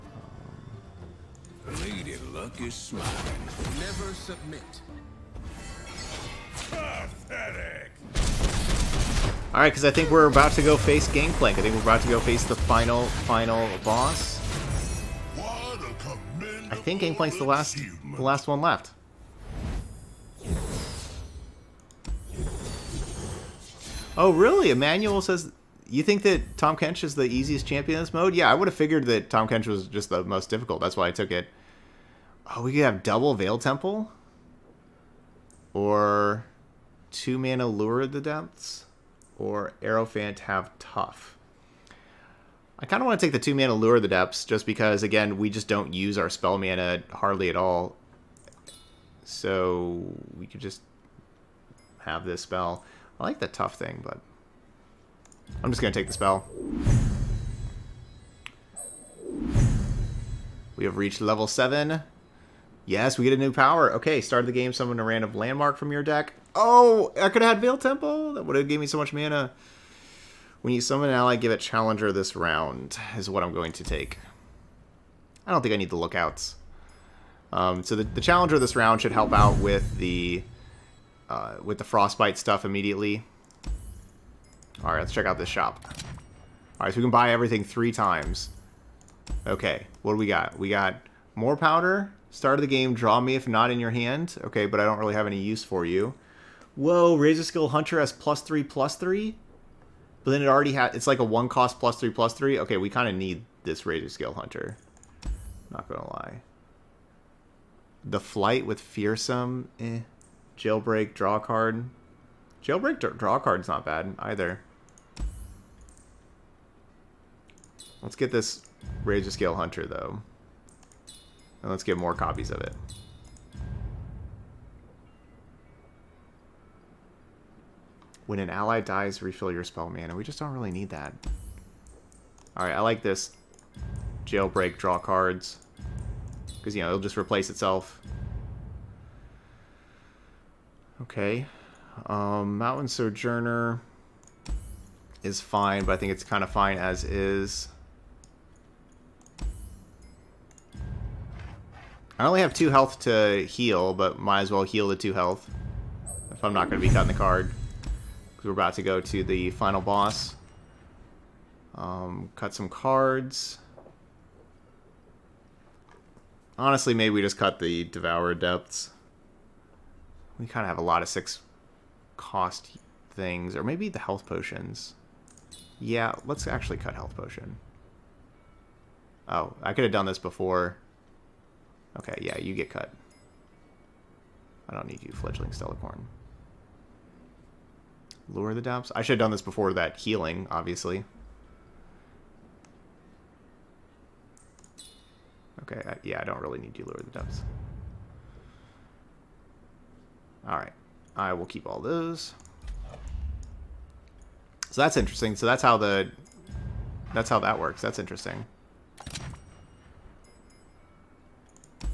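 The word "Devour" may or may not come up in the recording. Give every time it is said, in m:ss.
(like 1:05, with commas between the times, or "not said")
2:47.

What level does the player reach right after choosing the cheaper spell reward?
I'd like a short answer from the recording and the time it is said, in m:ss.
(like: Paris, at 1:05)
7, at 1:01.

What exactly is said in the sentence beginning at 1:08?
That would have gave me so much mana.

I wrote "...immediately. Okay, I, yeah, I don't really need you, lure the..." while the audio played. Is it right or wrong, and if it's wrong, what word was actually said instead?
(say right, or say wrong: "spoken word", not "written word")
wrong: "obviously", not "immediately".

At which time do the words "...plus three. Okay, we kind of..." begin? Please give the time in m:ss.
1:42.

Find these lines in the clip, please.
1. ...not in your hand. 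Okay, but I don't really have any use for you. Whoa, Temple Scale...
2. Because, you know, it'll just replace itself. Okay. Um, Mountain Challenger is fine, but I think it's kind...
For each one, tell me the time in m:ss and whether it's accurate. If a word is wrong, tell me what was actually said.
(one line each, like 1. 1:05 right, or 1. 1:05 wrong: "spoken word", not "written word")
1. 1:33 wrong: "Razor", not "Temple"
2. 2:16 wrong: "Sojourner", not "Challenger".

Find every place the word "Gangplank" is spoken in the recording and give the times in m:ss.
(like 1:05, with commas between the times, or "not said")
0:11, 0:17.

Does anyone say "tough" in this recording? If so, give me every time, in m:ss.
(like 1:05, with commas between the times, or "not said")
0:40, 0:53.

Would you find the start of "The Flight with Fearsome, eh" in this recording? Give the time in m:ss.
1:48.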